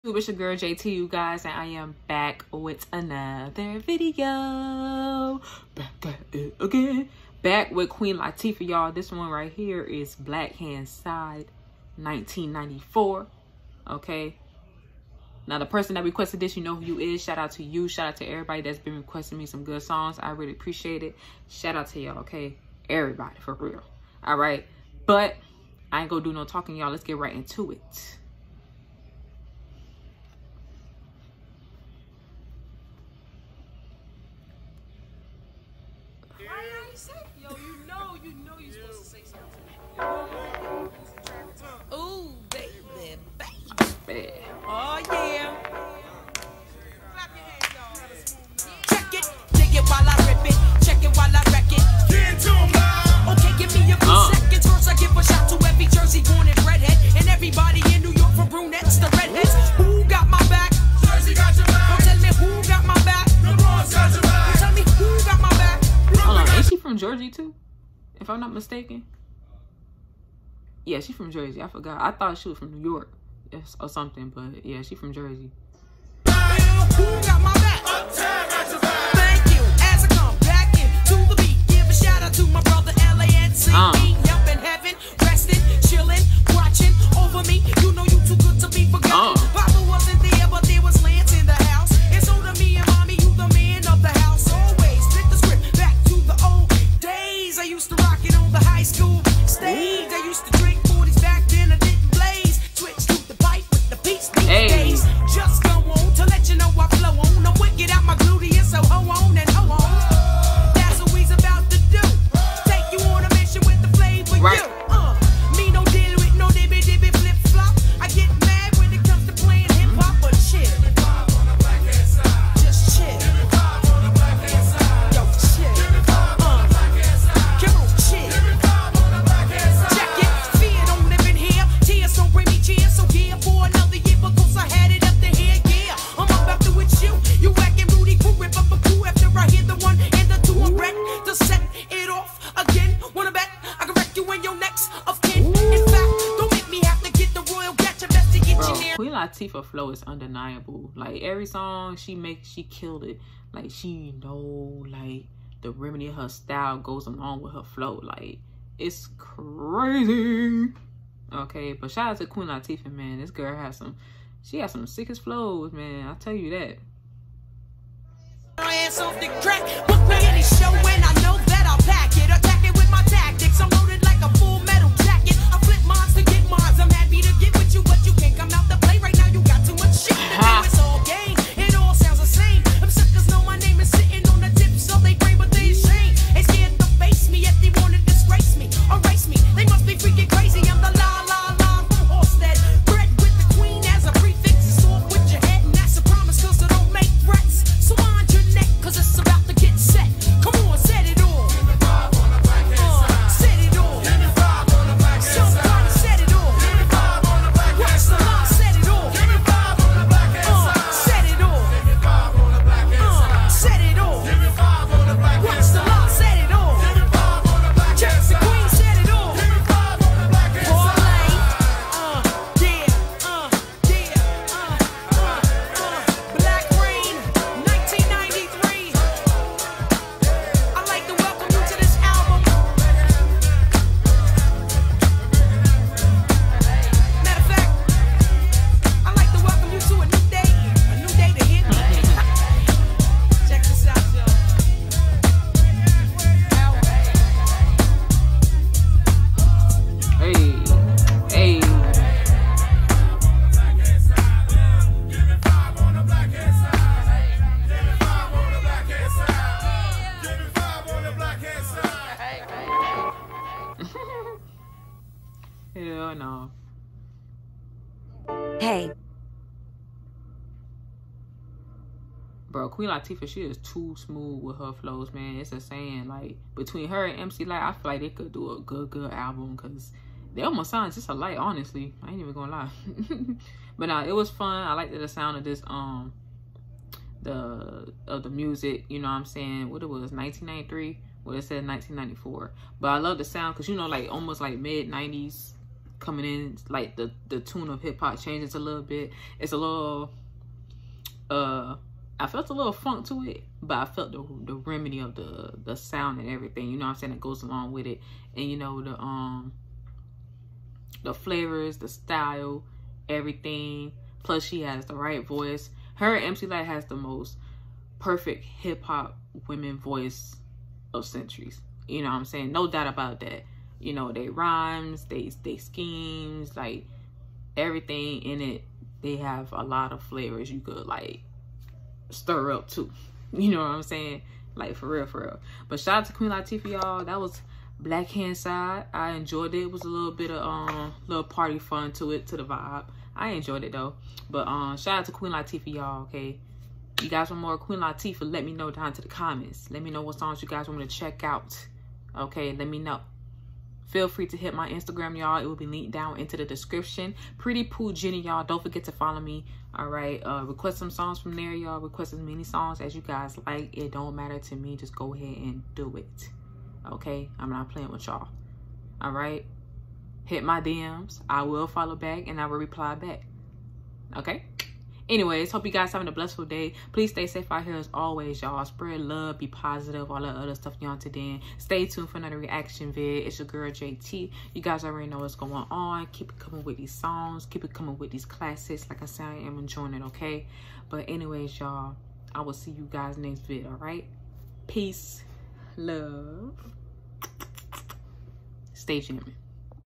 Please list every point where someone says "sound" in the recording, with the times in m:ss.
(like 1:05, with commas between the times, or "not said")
4:40, 4:45, 4:53, 5:05.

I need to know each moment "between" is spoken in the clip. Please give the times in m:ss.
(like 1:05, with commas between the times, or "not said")
4:36.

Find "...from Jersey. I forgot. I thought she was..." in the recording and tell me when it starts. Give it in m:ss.
1:11.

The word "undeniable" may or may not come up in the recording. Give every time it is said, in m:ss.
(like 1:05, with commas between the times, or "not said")
2:30.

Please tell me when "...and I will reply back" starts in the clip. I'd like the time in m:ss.
6:12.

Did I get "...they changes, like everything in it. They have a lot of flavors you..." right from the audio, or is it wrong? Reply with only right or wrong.
wrong.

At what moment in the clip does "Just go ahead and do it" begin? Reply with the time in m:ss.
6:04.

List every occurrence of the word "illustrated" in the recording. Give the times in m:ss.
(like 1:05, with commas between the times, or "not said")
not said.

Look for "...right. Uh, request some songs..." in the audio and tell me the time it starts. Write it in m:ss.
5:59.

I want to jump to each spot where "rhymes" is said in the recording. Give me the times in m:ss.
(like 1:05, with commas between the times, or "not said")
5:24.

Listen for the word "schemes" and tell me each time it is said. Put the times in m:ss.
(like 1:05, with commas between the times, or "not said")
5:25.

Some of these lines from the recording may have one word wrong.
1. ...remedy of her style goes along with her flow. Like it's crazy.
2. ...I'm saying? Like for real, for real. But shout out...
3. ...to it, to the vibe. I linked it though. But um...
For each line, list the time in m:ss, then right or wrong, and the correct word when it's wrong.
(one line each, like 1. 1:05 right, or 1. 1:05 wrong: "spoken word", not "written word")
1. 2:35 right
2. 5:33 right
3. 5:41 wrong: "enjoyed", not "linked".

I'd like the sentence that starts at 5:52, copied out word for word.
Okay, let me know feel free to hit my Instagram, y'all.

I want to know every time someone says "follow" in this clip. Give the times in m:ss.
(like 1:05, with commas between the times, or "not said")
5:58, 6:11.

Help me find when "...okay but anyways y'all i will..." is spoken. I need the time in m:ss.
6:30.